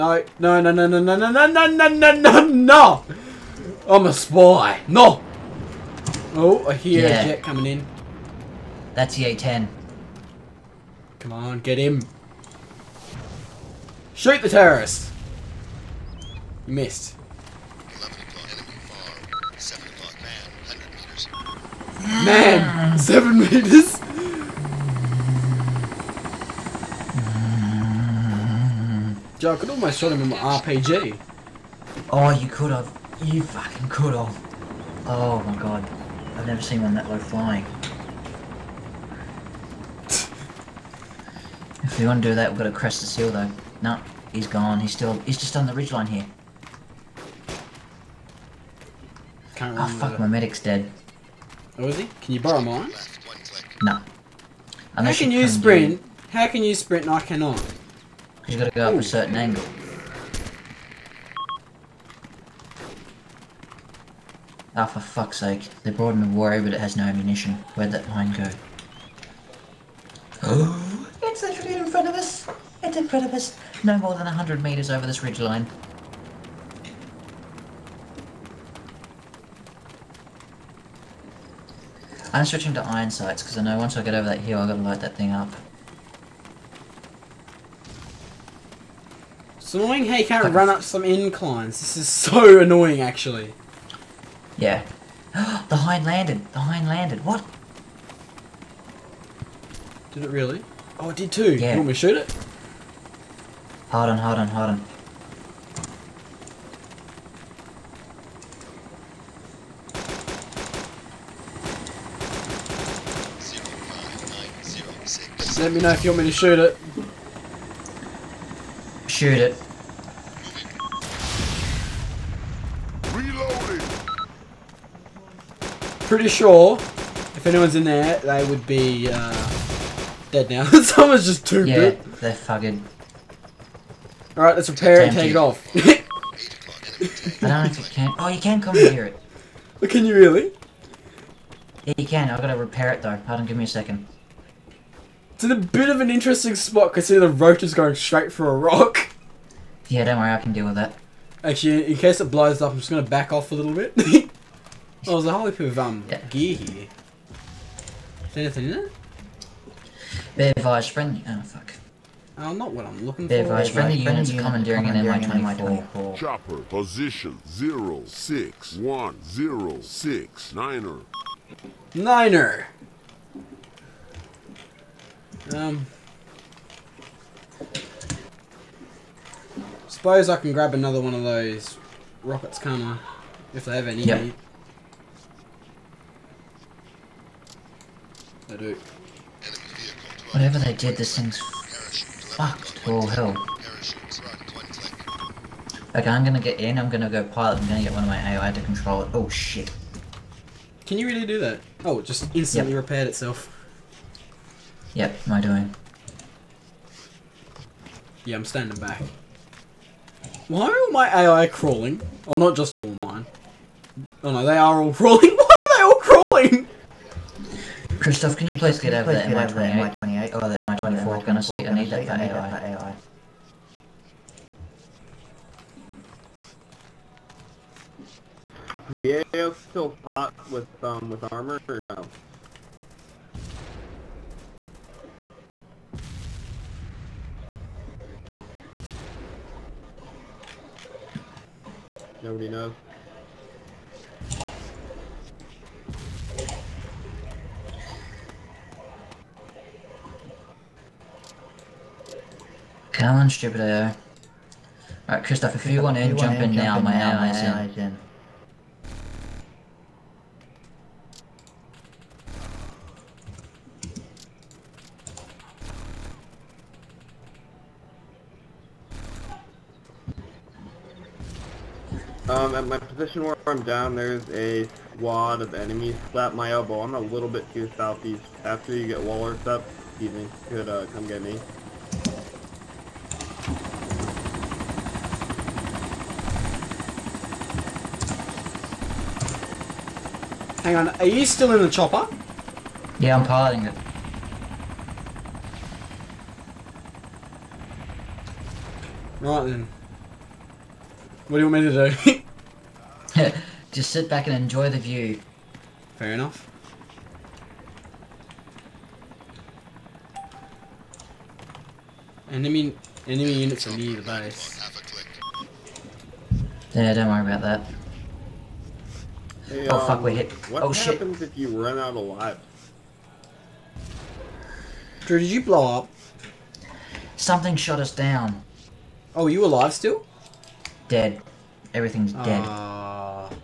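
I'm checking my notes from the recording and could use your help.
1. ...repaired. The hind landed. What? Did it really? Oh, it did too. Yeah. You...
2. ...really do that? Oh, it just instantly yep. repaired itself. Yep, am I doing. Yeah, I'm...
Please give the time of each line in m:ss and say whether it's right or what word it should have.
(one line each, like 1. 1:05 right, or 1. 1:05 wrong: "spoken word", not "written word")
1. 1:36 wrong: "landed", not "repaired"
2. 3:21 right.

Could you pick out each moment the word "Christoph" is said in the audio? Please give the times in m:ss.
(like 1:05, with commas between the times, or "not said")
3:37, 4:15.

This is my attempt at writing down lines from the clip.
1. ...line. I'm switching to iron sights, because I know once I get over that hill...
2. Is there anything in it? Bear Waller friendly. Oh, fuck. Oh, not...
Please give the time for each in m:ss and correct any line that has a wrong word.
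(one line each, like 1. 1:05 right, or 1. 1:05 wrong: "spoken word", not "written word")
1. 1:15 right
2. 2:38 wrong: "Vise", not "Waller".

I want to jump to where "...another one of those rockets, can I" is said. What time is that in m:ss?
3:00.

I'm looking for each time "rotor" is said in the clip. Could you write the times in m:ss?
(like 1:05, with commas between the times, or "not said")
2:27.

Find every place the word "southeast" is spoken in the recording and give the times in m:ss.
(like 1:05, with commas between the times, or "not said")
4:37.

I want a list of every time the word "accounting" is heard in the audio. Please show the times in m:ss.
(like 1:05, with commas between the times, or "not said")
not said.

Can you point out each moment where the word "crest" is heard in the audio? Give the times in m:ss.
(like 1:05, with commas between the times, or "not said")
0:42.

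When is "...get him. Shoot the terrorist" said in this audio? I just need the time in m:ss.
0:11.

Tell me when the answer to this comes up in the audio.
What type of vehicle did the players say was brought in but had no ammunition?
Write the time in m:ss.
1:06.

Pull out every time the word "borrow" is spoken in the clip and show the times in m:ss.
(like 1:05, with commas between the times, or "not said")
0:52.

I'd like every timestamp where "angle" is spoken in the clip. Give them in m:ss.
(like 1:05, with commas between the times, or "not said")
0:59.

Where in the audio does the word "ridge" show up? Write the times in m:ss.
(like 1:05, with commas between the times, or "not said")
0:45, 1:15.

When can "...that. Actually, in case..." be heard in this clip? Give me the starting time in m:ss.
2:30.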